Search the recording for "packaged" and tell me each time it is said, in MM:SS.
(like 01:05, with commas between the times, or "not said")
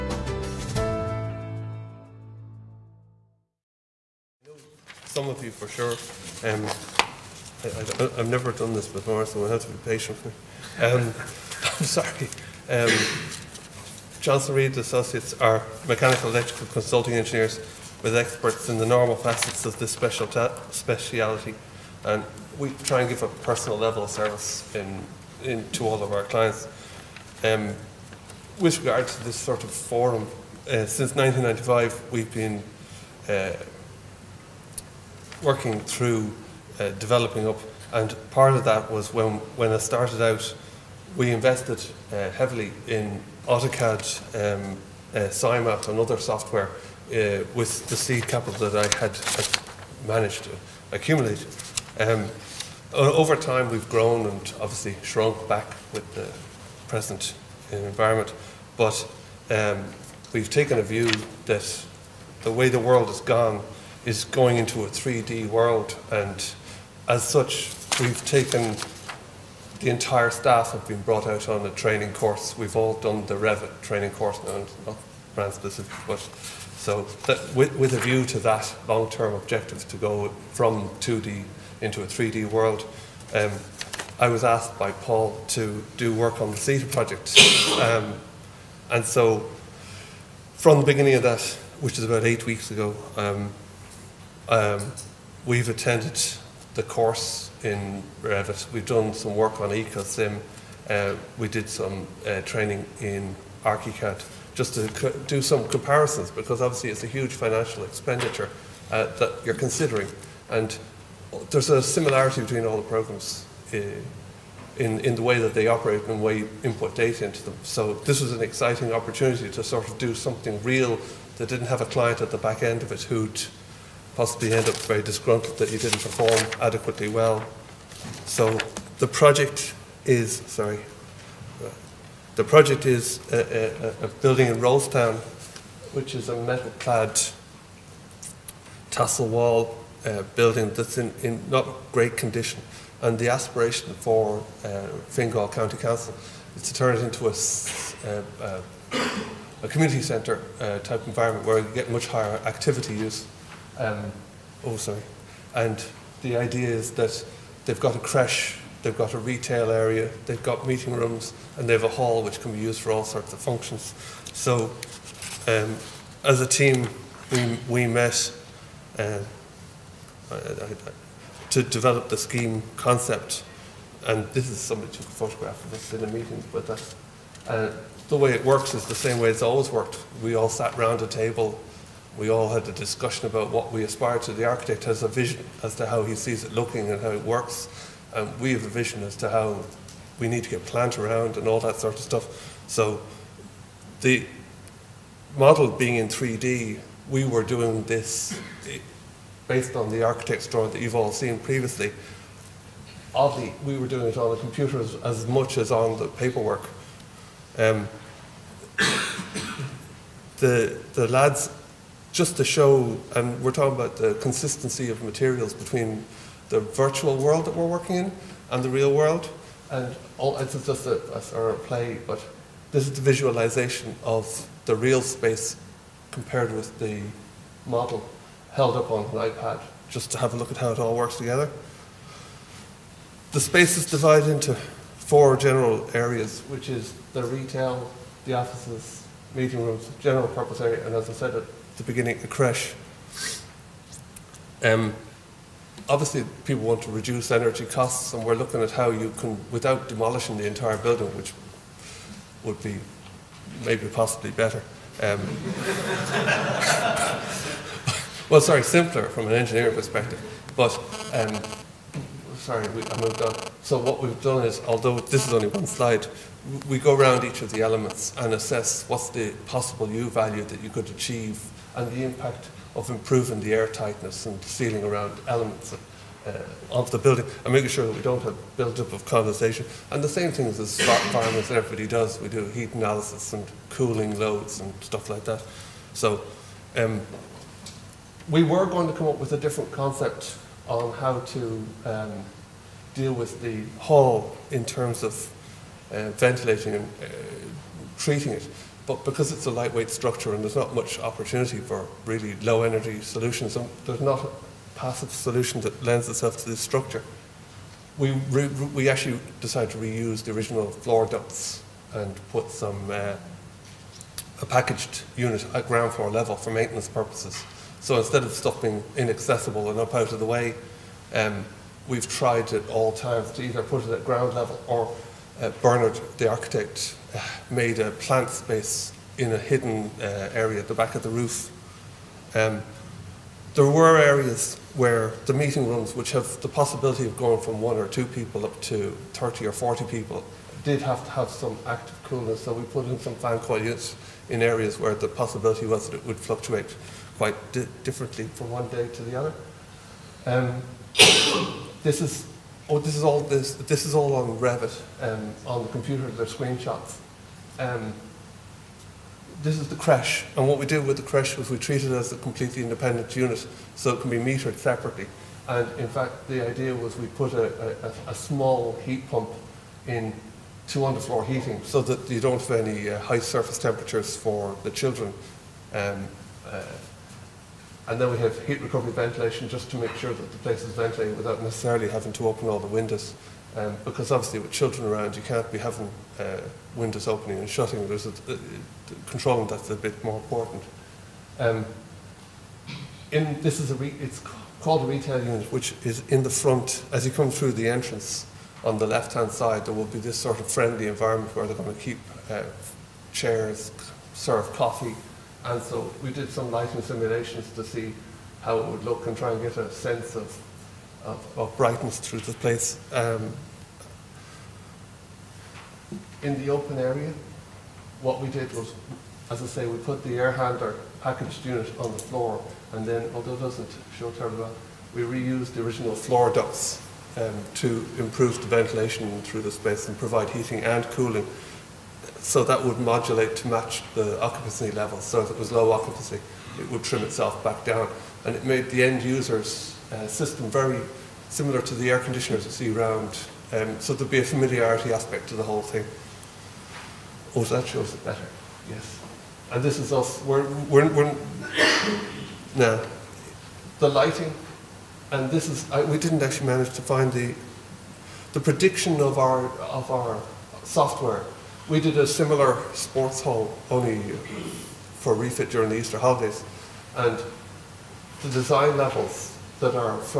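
05:14, 07:01.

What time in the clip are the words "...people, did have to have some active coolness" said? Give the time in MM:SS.
05:39.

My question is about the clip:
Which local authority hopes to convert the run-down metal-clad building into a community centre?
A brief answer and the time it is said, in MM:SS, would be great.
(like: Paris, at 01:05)
Fingal County Council, at 02:25.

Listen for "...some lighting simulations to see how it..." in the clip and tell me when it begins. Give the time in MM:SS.
06:46.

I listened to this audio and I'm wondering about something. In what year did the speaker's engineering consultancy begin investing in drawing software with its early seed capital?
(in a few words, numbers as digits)
1995.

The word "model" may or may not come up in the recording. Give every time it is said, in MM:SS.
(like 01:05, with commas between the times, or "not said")
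03:15, 03:47.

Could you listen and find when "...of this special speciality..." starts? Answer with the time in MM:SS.
00:19.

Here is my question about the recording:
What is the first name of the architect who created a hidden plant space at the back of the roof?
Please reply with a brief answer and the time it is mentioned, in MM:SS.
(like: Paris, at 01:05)
Bernard, at 05:25.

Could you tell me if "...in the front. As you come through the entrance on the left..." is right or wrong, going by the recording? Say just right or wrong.
right.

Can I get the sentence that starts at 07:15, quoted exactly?
So if it was low occupancy, it would trim itself back down.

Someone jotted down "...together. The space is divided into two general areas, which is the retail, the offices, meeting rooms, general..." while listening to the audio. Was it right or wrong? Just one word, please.
wrong.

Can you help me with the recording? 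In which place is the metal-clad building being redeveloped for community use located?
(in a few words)
Rolestown.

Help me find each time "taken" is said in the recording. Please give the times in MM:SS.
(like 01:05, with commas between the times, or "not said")
01:00, 01:08.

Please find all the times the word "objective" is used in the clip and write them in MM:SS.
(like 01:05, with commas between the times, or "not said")
01:19.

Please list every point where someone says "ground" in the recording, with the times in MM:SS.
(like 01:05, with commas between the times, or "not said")
05:15, 05:24.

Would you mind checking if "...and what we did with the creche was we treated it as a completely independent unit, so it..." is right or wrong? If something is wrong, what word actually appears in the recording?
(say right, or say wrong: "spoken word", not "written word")
right.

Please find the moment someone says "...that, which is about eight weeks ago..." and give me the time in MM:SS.
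01:31.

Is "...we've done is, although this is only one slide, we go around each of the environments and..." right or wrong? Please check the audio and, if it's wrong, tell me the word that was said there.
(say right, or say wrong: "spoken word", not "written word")
wrong: "elements", not "environments".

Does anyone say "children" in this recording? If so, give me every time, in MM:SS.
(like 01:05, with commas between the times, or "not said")
06:14, 06:24.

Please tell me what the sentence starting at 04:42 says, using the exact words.
We do heat analysis and cooling loads and stuff like that.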